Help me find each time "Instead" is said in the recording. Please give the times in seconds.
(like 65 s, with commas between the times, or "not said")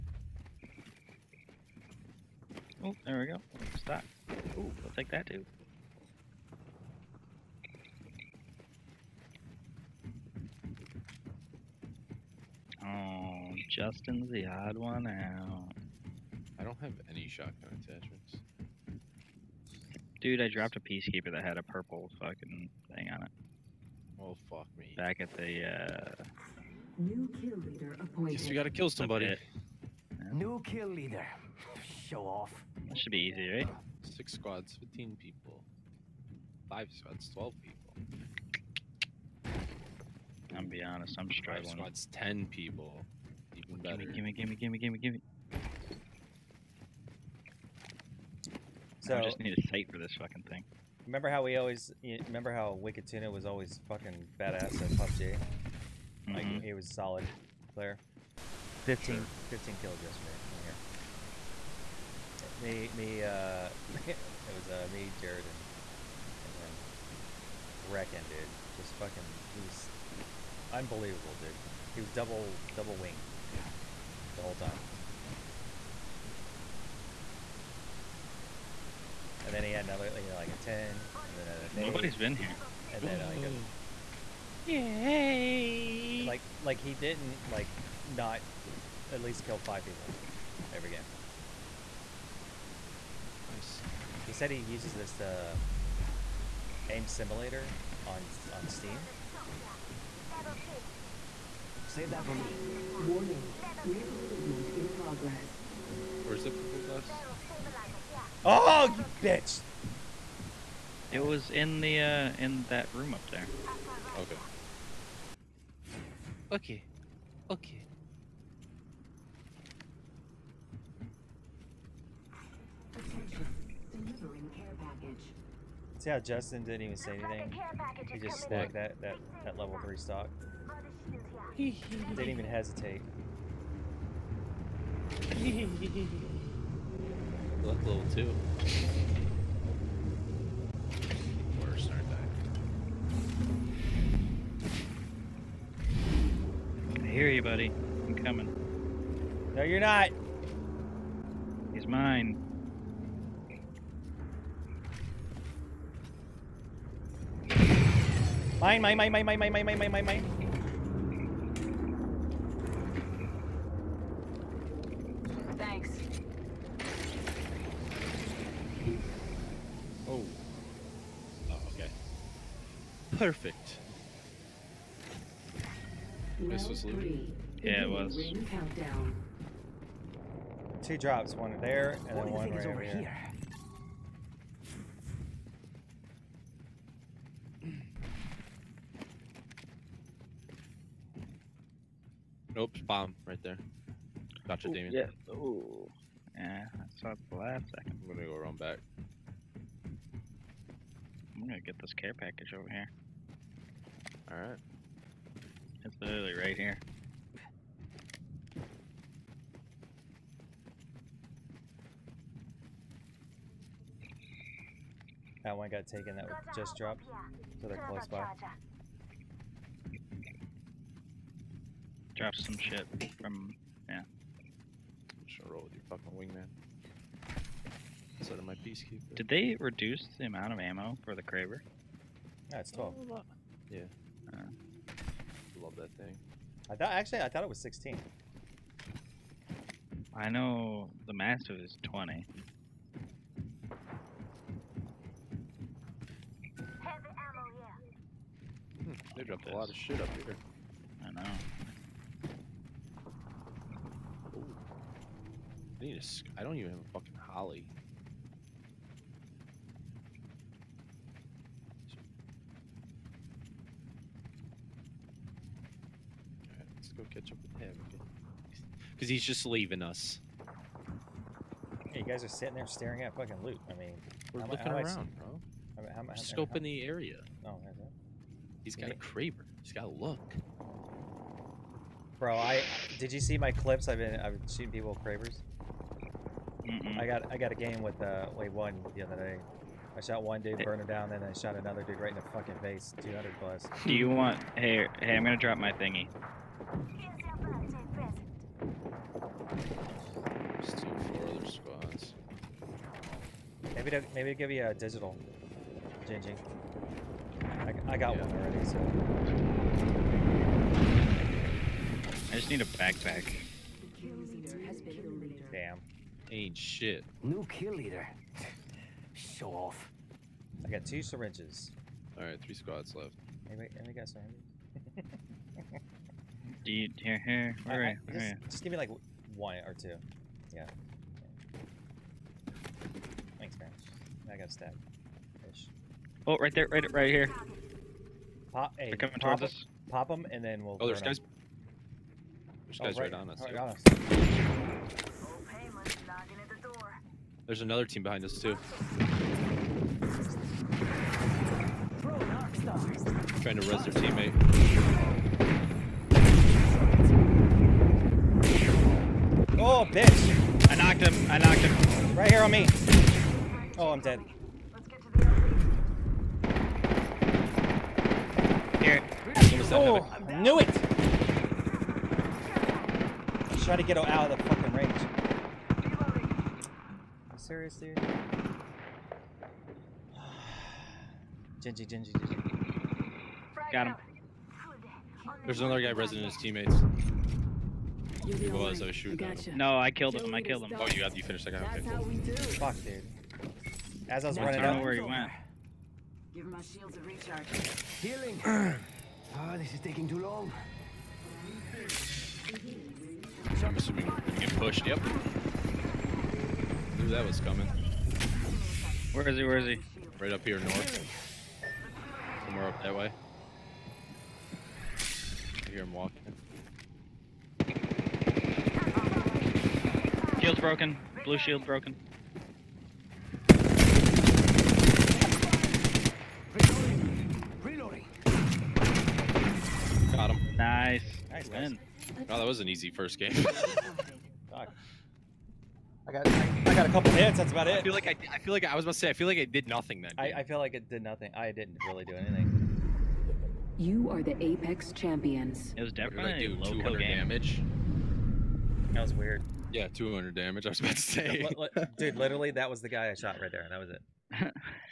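228 s.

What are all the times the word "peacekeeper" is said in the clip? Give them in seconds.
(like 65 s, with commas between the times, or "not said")
20 s, 228 s.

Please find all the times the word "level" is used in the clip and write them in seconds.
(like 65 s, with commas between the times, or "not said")
129 s, 137 s.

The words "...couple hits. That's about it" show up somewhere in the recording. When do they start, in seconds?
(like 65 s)
436 s.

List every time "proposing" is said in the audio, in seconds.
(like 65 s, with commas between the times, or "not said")
not said.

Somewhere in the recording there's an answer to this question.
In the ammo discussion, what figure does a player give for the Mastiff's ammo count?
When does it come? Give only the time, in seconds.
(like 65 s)
241 s.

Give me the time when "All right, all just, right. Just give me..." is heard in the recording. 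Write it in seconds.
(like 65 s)
327 s.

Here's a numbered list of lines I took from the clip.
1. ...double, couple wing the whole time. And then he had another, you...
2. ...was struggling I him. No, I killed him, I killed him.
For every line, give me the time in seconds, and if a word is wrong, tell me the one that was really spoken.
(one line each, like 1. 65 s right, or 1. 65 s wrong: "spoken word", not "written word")
1. 72 s wrong: "double", not "couple"
2. 388 s wrong: "shooting", not "struggling".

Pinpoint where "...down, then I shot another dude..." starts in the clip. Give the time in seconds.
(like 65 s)
290 s.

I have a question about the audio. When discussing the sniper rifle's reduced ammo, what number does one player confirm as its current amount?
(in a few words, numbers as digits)
12.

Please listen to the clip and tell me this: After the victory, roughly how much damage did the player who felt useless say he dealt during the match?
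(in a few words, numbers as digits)
200.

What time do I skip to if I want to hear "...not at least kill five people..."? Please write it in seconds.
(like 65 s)
88 s.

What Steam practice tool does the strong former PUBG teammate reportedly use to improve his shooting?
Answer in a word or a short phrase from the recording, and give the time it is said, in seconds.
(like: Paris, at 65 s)
aim simulator, at 96 s.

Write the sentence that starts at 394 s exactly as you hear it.
As I was running I don't know where he went.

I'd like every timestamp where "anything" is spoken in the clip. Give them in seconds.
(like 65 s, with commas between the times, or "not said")
127 s, 442 s.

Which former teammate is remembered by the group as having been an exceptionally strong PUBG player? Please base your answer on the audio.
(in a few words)
Wicked Tuna.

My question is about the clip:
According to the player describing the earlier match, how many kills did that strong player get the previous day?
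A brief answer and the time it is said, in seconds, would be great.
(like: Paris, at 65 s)
15, at 59 s.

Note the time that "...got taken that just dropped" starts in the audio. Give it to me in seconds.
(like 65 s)
215 s.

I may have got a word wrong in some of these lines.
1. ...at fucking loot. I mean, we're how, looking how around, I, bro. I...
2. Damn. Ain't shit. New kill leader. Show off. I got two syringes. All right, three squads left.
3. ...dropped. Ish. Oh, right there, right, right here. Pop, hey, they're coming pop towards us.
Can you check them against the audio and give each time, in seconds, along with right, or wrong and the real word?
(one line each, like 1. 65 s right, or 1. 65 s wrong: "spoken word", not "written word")
1. 273 s right
2. 315 s right
3. 334 s wrong: "stabbed", not "dropped".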